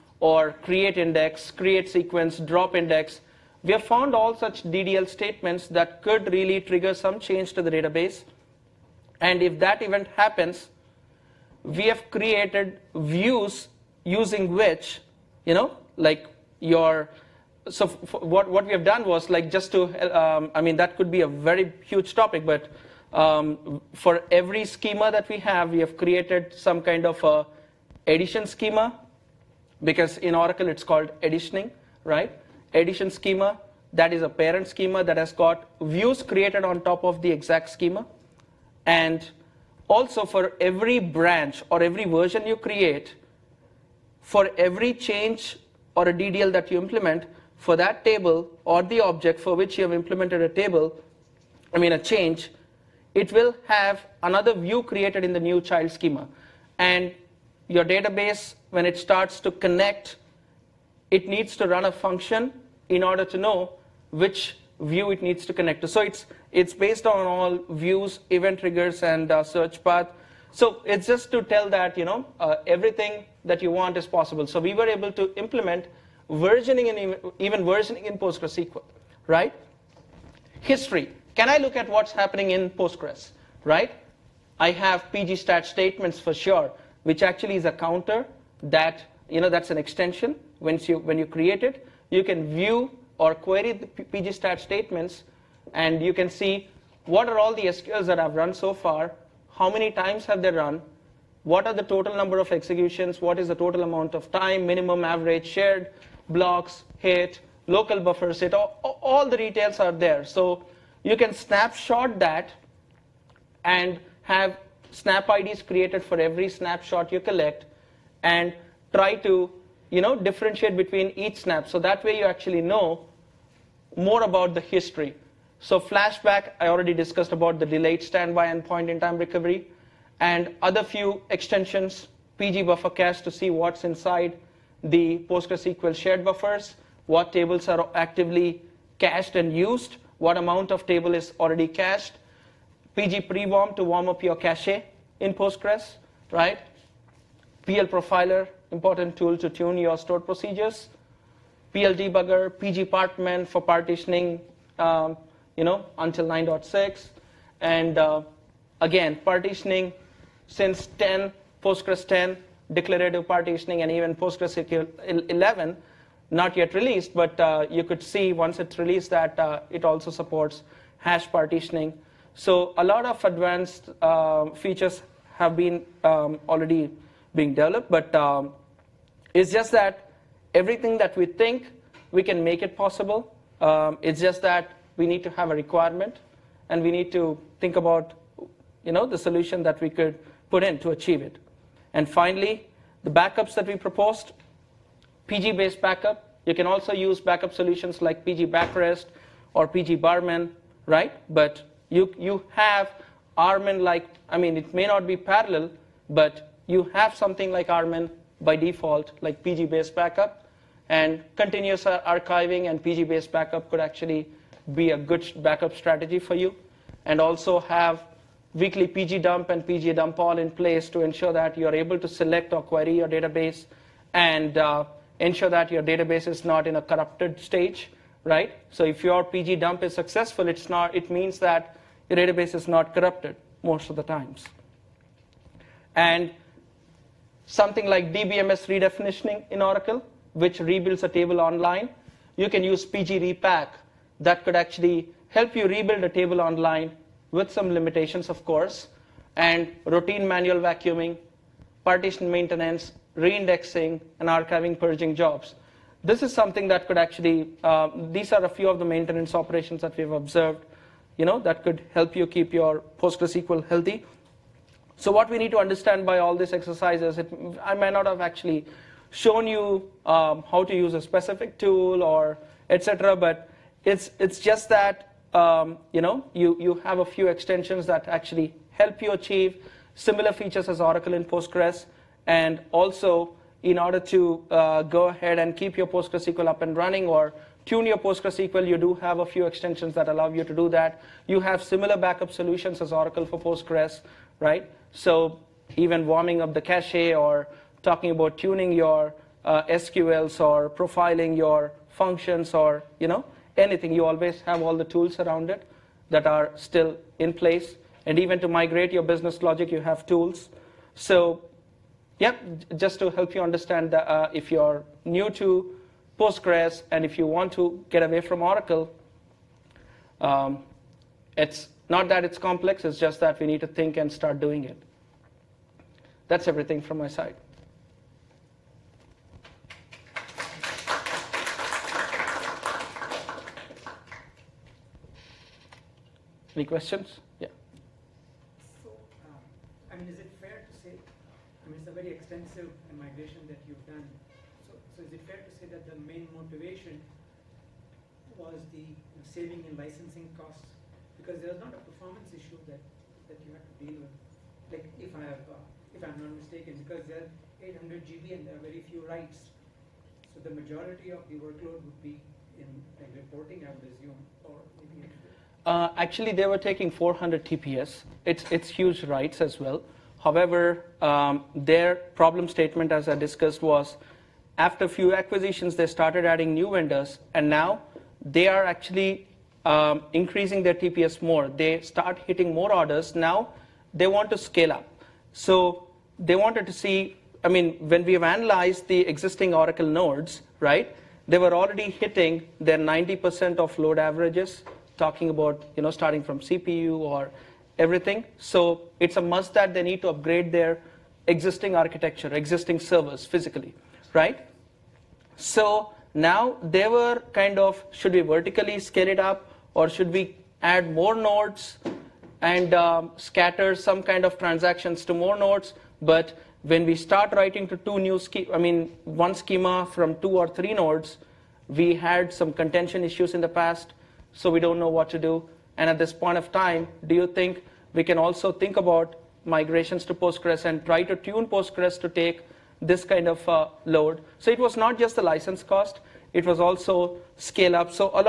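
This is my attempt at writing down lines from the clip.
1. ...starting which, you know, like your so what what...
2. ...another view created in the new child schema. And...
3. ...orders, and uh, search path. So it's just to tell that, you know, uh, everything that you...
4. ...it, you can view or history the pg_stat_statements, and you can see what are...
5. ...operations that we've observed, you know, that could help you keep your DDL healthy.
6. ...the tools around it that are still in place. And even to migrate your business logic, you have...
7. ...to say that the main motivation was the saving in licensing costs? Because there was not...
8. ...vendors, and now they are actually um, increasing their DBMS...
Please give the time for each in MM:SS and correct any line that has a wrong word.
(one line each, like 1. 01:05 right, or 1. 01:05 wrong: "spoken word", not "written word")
1. 00:14 wrong: "using", not "starting"
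2. 00:54 right
3. 01:08 wrong: "triggers", not "orders"
4. 01:31 wrong: "query", not "history"
5. 04:19 wrong: "PostgreSQL", not "DDL"
6. 05:04 right
7. 05:45 right
8. 06:16 wrong: "TPS", not "DBMS".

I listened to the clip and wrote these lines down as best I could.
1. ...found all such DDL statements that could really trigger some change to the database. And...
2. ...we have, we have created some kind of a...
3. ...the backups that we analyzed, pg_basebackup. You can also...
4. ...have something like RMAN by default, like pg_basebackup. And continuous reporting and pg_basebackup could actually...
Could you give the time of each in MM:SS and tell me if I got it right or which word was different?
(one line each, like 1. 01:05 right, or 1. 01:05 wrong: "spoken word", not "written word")
1. 00:03 right
2. 00:25 right
3. 03:13 wrong: "proposed", not "analyzed"
4. 03:26 wrong: "archiving", not "reporting".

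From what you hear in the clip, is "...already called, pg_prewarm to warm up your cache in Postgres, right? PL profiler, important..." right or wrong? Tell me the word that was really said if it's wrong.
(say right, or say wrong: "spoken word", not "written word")
wrong: "cached", not "called".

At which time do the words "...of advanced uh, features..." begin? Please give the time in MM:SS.
02:53.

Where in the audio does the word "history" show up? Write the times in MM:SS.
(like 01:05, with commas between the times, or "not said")
01:20, 02:04.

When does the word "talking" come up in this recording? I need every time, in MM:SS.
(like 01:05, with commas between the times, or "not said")
04:57, 06:35.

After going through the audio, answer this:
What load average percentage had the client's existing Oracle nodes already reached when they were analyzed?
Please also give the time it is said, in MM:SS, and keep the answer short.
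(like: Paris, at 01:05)
90%, at 06:32.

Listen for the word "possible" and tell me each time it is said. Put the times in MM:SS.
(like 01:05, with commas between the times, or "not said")
01:14, 03:02.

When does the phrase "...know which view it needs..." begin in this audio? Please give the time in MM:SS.
01:03.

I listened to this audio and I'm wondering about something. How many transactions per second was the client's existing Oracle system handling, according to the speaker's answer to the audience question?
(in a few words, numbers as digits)
400.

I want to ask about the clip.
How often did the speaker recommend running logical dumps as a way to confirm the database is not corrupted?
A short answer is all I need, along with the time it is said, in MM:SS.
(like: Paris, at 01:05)
Weekly, at 03:38.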